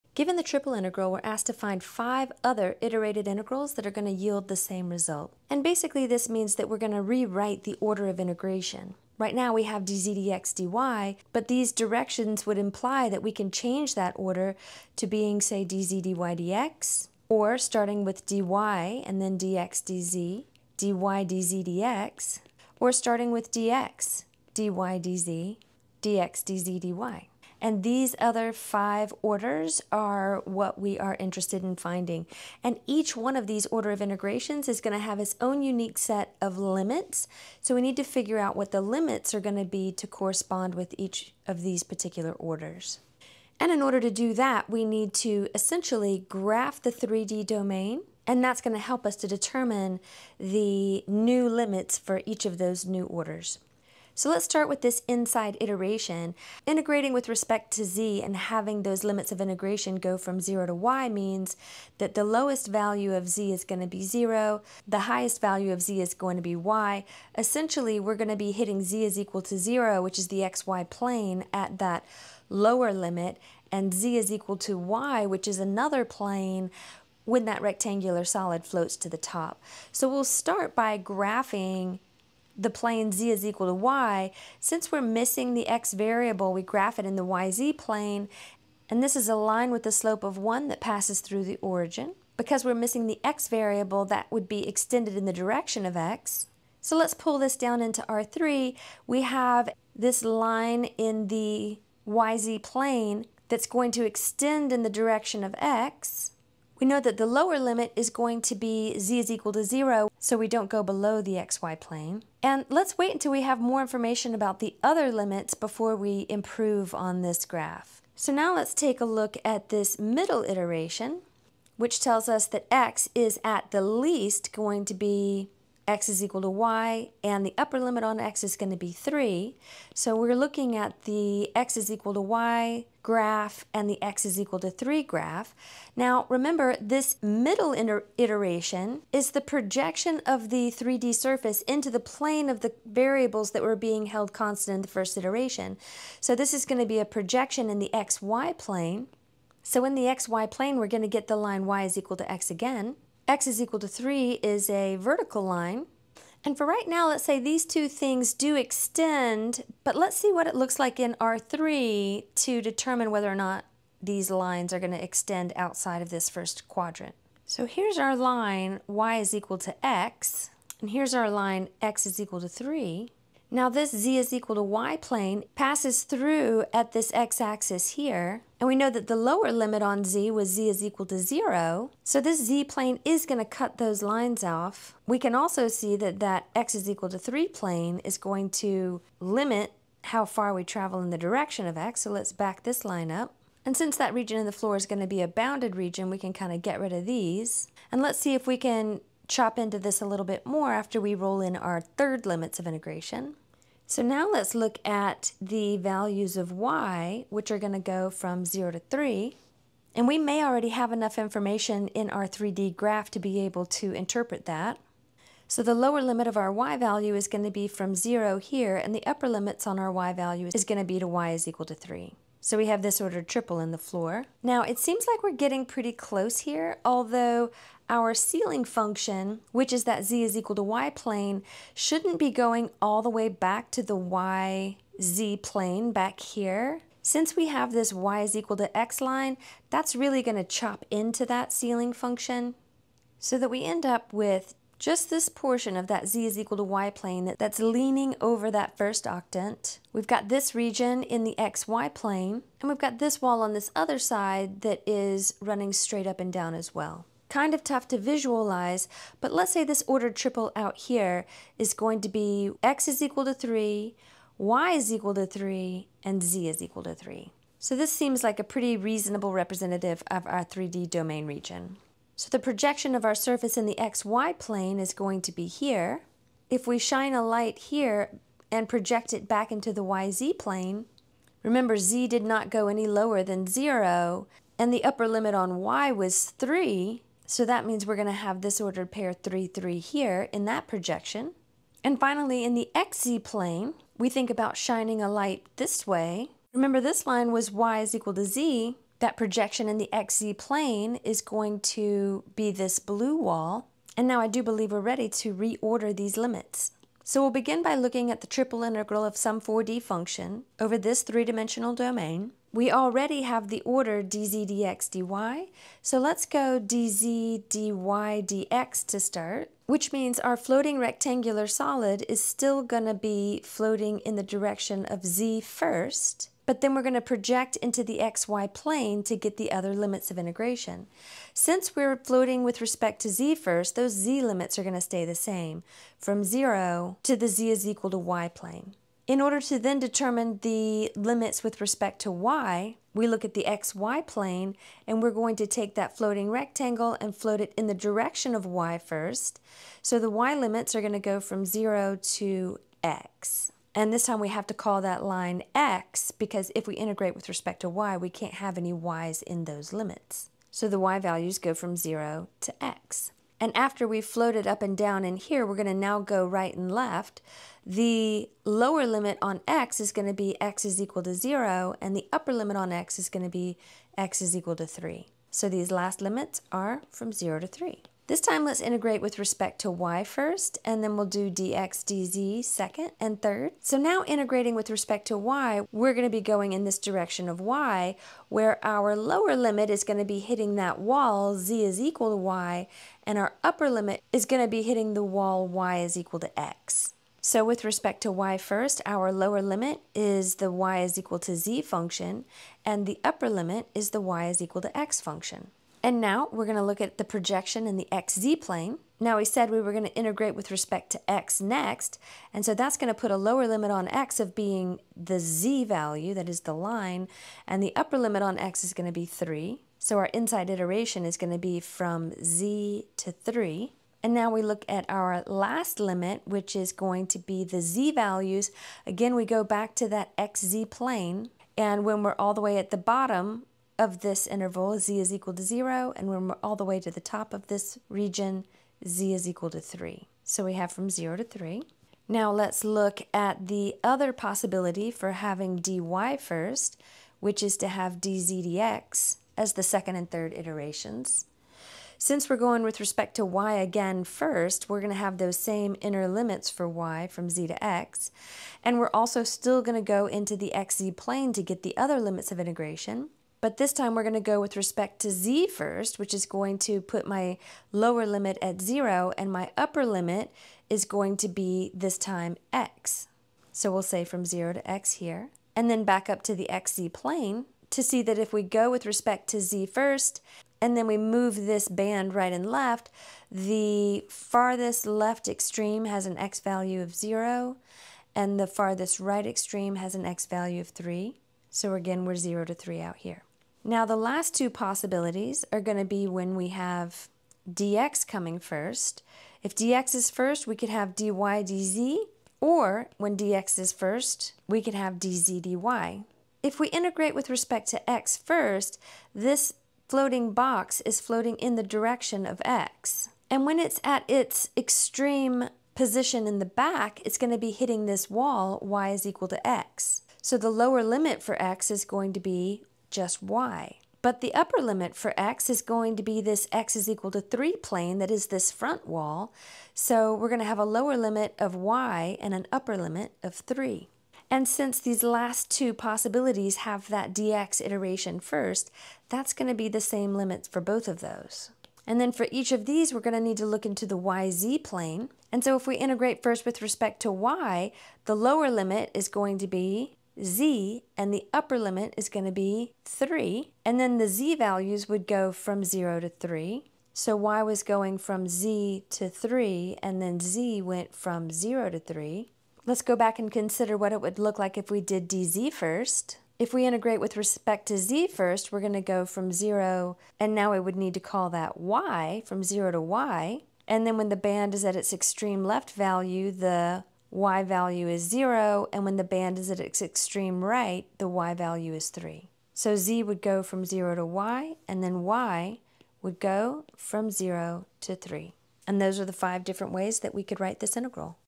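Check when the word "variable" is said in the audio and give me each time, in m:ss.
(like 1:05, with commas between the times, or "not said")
1:25, 1:33, 2:22.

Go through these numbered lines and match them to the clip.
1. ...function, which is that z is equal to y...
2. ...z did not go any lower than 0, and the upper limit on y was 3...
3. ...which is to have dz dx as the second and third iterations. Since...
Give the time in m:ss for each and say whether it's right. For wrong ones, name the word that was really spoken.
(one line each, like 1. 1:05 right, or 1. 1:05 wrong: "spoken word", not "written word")
1. 3:48 right
2. 4:41 right
3. 7:27 right.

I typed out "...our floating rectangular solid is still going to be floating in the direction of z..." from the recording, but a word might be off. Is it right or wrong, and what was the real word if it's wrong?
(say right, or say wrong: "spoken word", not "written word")
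right.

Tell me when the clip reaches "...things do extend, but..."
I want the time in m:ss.
2:37.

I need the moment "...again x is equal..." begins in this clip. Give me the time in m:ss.
2:32.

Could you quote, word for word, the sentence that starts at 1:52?
And let's wait until we have more information about the other limits before we improve on this graph.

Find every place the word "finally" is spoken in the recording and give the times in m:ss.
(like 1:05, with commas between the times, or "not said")
4:51.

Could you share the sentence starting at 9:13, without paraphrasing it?
And then the z values would go from 0 to 3.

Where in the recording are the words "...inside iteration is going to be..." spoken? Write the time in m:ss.
7:00.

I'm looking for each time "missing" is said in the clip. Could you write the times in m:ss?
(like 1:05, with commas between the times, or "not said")
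1:25, 1:32.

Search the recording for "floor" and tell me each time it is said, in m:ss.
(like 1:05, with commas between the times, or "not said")
3:14, 3:43.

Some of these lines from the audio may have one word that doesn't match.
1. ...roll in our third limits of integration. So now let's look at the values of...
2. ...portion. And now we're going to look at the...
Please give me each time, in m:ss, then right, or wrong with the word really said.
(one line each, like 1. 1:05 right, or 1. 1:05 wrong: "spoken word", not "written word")
1. 3:21 right
2. 6:44 wrong: "function", not "portion".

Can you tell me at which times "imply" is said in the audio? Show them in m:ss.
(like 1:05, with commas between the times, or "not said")
0:12.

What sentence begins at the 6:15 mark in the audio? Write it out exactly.
So these last limits are from 0 to 3.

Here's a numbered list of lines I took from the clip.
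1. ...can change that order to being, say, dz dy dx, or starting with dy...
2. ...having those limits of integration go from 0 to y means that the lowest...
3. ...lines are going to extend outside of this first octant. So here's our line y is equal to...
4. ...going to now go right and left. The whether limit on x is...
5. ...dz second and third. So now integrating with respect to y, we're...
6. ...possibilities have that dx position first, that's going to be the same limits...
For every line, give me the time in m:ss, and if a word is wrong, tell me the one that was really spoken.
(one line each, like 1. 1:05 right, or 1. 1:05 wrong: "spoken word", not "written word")
1. 0:13 right
2. 0:58 right
3. 2:44 wrong: "quadrant", not "octant"
4. 6:05 wrong: "lower", not "whether"
5. 6:21 right
6. 8:55 wrong: "iteration", not "position".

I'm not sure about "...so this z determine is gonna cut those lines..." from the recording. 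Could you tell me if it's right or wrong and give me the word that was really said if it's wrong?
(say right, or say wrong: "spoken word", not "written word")
wrong: "plane", not "determine".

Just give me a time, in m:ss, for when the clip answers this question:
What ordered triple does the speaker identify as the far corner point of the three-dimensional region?
4:22.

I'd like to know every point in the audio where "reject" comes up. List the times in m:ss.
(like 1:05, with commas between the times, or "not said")
not said.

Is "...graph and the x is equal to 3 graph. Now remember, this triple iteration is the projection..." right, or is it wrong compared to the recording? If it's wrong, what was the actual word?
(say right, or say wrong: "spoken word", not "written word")
wrong: "middle", not "triple".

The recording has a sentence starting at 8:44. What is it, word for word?
But the upper limit for x is going to be this x is equal to 3 plane, that is this front wall.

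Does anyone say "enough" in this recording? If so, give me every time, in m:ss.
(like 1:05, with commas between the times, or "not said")
3:30.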